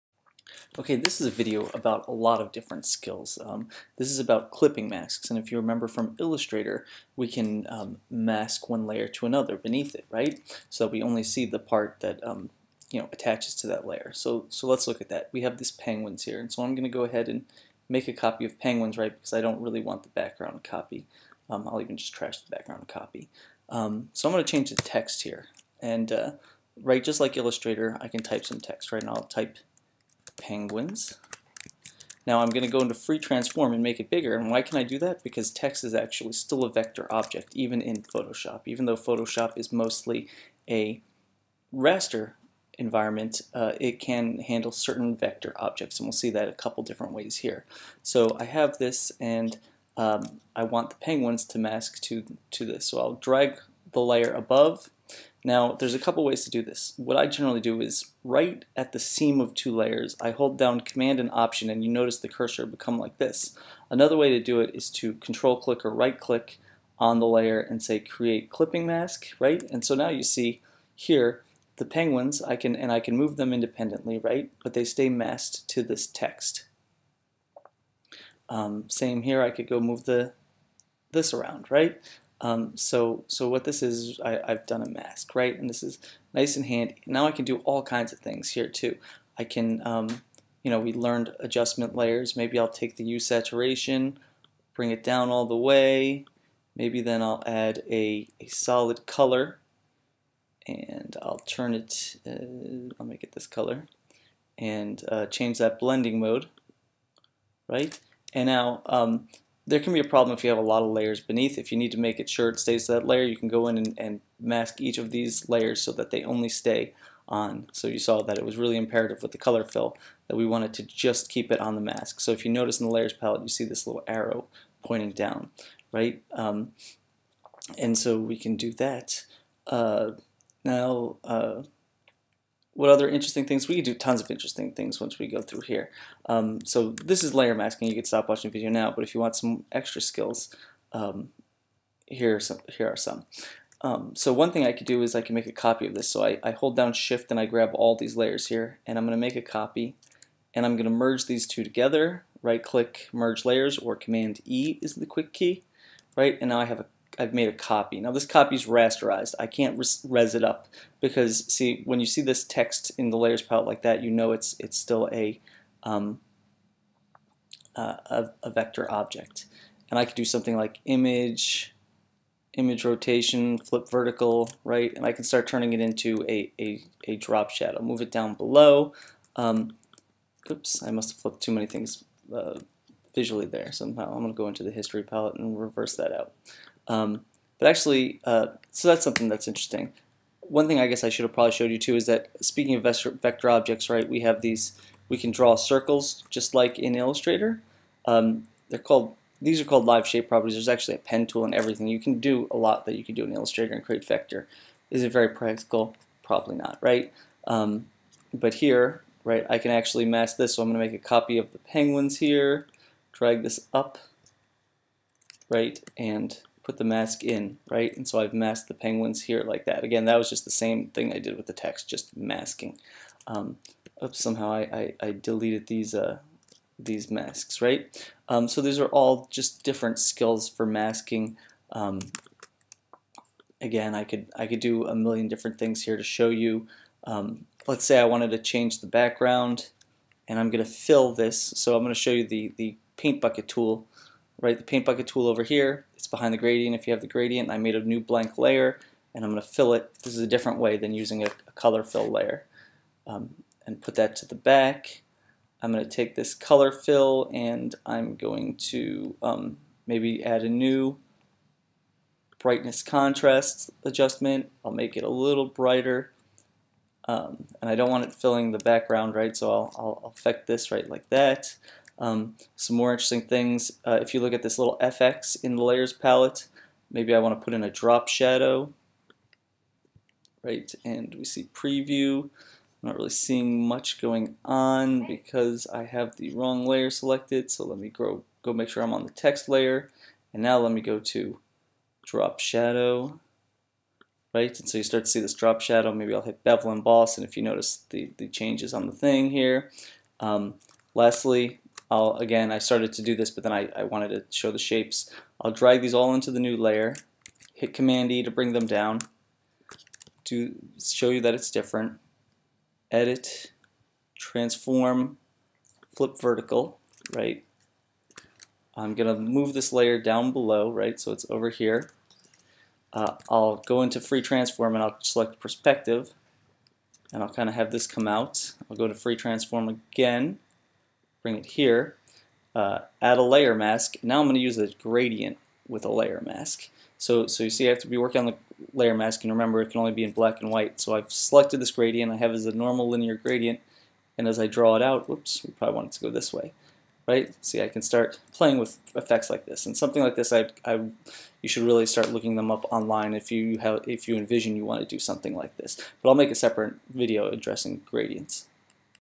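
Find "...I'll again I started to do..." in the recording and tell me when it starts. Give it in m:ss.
5:01.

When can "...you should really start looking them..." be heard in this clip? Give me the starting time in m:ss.
5:51.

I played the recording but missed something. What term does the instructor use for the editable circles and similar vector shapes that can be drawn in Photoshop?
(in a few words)
live shape properties.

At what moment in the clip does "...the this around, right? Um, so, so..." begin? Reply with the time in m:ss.
1:20.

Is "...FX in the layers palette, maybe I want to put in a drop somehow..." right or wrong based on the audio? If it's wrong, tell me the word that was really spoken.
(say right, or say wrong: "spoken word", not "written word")
wrong: "shadow", not "somehow".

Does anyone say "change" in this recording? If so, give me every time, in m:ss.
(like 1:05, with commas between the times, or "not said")
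0:24, 1:45, 3:58, 4:58.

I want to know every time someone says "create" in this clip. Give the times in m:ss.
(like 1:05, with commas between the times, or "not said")
1:07, 3:23.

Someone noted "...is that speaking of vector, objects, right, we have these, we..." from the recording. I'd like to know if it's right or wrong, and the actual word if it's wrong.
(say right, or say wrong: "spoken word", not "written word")
right.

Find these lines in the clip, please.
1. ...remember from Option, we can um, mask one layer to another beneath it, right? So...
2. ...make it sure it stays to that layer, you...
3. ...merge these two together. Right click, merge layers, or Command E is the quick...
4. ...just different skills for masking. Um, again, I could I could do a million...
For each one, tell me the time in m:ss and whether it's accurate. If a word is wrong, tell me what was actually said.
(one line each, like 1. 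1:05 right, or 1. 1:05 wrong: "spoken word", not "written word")
1. 0:05 wrong: "Illustrator", not "Option"
2. 1:51 right
3. 2:30 right
4. 3:49 right.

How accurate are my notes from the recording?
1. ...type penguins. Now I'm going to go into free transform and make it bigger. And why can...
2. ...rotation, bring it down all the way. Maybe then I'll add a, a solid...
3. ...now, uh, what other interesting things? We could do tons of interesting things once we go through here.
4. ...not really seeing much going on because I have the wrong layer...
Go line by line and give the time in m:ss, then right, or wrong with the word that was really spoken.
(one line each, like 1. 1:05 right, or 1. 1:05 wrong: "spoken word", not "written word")
1. 0:29 right
2. 1:33 wrong: "saturation", not "rotation"
3. 2:10 right
4. 4:42 right.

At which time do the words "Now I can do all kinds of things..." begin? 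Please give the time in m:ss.
1:27.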